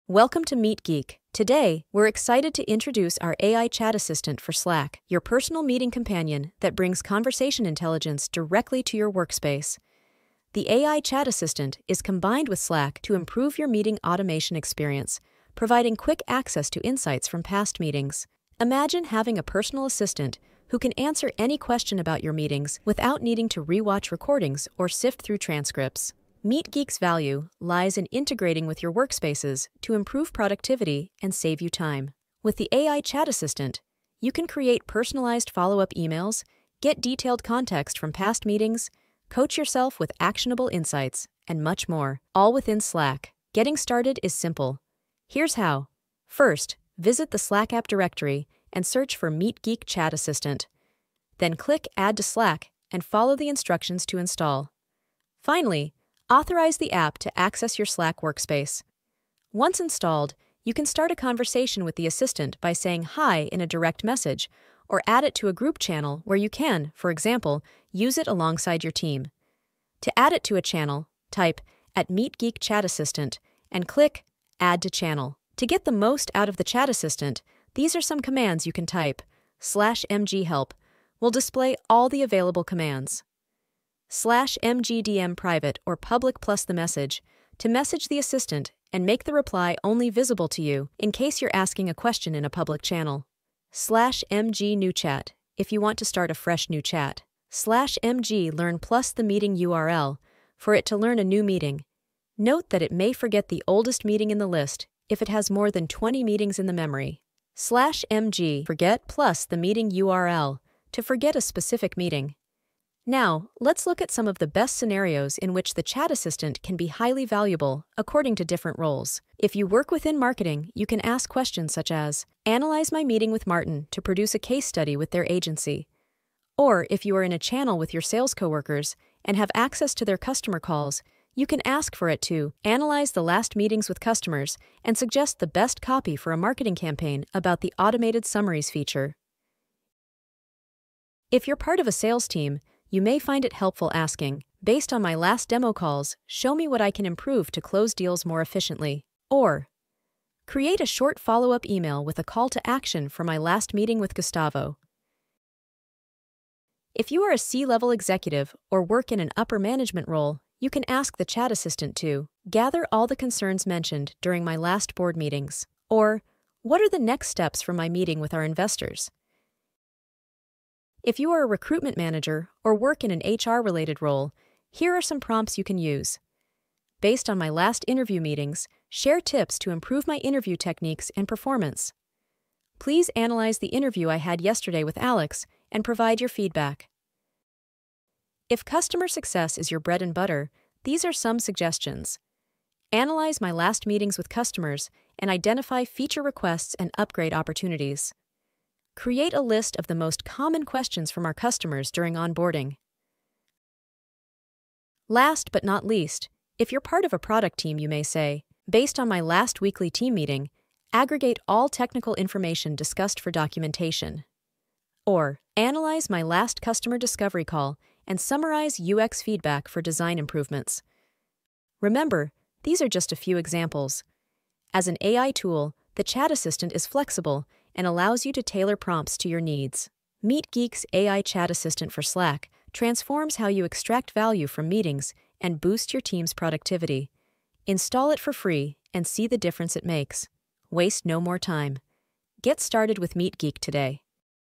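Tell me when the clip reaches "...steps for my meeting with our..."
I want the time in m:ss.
2:47.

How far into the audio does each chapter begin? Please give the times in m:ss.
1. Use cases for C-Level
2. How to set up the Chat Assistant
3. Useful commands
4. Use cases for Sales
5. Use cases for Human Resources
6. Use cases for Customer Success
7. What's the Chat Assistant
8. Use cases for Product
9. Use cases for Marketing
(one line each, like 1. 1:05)
1. 2:36
2. 0:43
3. 1:15
4. 2:20
5. 2:50
6. 3:08
7. 0:10
8. 3:25
9. 1:58.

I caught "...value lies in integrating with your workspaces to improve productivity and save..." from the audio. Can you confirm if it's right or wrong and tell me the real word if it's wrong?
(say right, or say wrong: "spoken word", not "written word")
right.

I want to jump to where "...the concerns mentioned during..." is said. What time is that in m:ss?
2:43.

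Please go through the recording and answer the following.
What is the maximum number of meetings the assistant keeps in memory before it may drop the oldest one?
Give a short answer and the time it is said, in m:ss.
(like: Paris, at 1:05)
20, at 1:45.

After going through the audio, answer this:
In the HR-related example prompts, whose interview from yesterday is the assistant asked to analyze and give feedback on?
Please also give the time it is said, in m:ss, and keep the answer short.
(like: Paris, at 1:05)
Alex, at 3:04.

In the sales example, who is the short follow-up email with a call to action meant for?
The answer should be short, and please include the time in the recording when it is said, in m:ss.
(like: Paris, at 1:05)
Gustavo, at 2:34.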